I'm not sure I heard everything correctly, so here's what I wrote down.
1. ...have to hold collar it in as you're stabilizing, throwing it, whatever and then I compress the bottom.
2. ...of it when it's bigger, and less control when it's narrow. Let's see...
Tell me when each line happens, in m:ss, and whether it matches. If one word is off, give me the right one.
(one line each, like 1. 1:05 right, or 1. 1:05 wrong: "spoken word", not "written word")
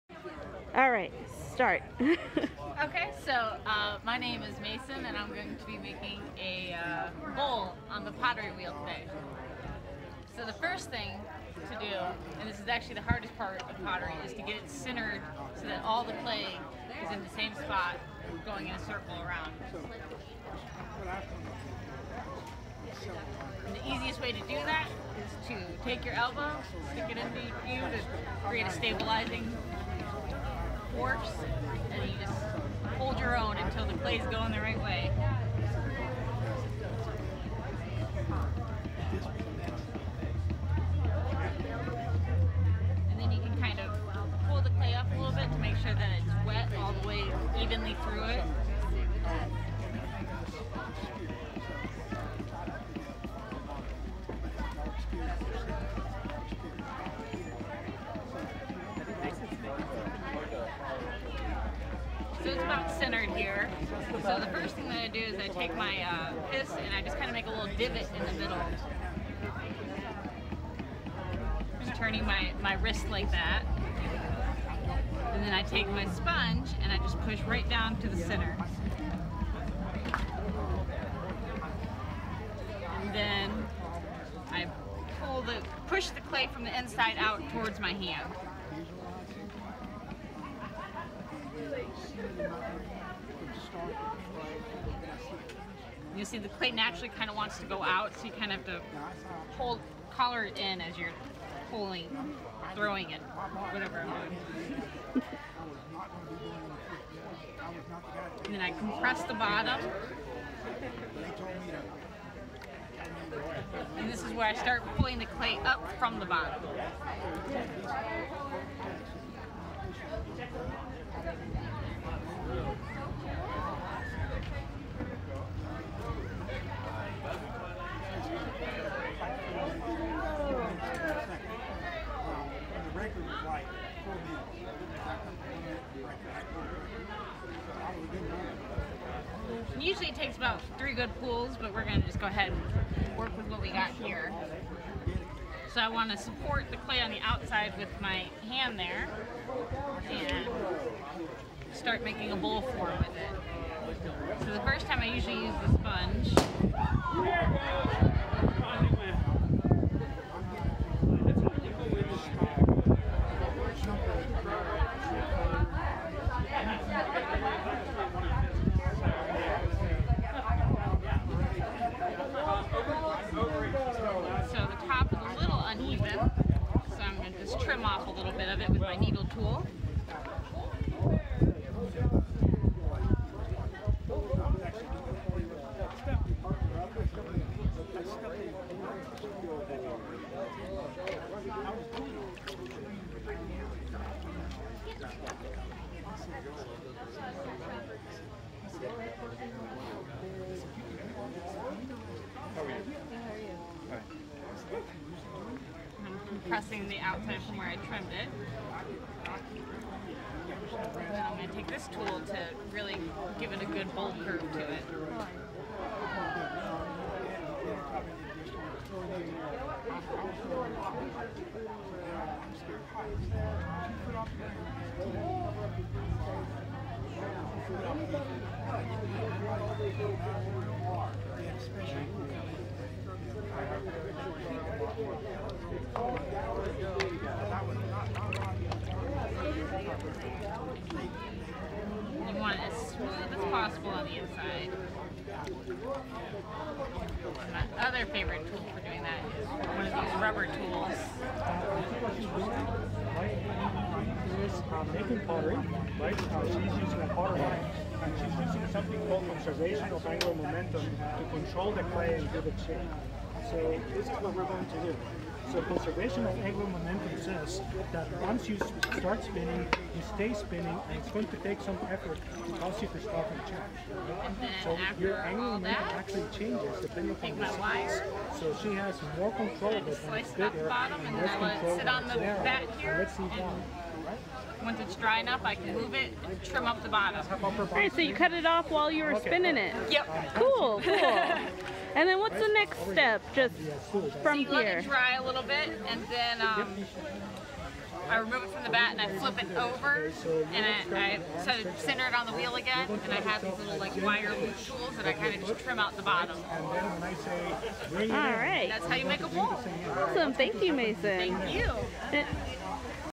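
1. 1:38 wrong: "pulling", not "stabilizing"
2. 4:39 right.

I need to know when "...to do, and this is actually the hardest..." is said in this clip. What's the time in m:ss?
0:11.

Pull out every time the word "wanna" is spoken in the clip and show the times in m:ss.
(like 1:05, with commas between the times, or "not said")
2:25.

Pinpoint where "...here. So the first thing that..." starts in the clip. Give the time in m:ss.
1:03.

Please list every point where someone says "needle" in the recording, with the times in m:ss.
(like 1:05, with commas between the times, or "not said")
2:58.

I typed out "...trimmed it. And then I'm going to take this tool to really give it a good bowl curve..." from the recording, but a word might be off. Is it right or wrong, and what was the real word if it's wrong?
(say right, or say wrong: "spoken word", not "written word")
right.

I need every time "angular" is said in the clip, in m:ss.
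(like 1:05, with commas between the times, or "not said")
4:20, 4:26, 4:35.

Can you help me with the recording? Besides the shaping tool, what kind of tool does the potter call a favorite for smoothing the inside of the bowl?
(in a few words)
Rubber tools.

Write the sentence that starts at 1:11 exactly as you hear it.
Just turning my, my wrist like that.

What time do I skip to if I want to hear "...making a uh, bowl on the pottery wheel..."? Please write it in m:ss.
0:05.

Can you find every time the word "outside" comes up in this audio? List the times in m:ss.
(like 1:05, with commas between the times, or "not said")
2:27, 3:26.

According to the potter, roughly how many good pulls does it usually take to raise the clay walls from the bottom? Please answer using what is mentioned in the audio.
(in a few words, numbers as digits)
3.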